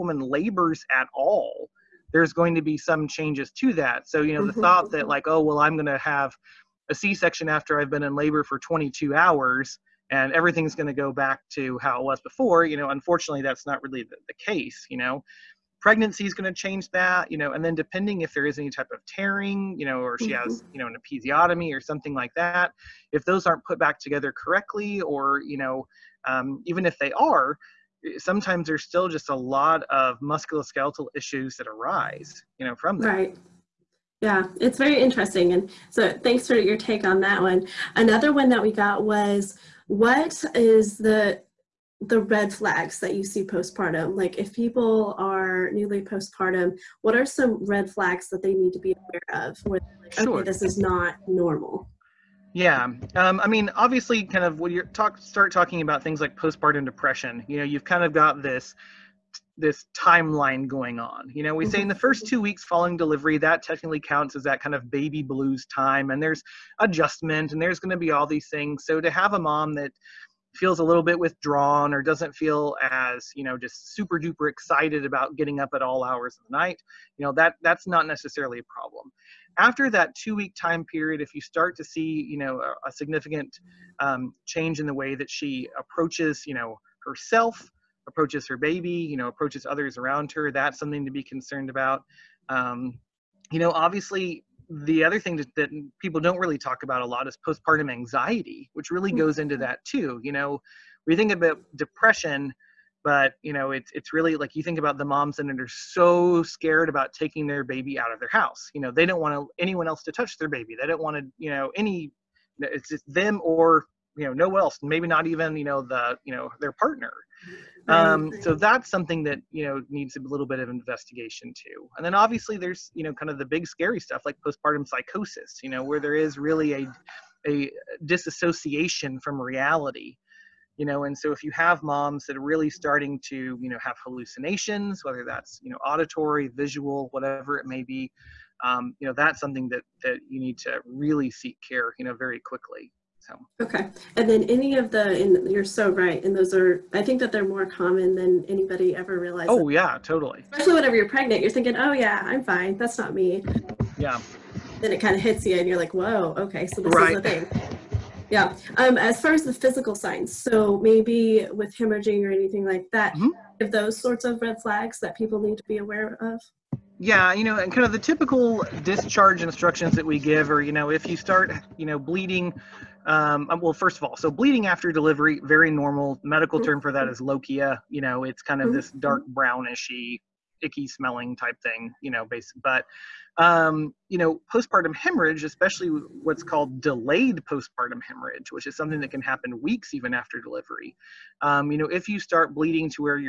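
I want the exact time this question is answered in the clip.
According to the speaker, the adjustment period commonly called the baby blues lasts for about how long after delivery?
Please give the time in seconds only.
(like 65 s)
62 s.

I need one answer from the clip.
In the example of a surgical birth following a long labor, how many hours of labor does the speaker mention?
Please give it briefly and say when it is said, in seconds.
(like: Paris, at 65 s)
22, at 8 s.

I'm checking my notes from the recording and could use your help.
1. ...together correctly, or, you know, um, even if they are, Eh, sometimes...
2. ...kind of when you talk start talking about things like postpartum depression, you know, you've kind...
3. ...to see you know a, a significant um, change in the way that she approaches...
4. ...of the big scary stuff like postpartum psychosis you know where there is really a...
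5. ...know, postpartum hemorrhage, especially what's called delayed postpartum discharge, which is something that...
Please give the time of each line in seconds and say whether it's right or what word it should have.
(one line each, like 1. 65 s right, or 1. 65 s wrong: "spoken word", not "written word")
1. 23 s right
2. 54 s right
3. 81 s right
4. 123 s right
5. 184 s wrong: "hemorrhage", not "discharge".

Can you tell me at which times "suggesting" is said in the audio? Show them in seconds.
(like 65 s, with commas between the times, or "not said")
not said.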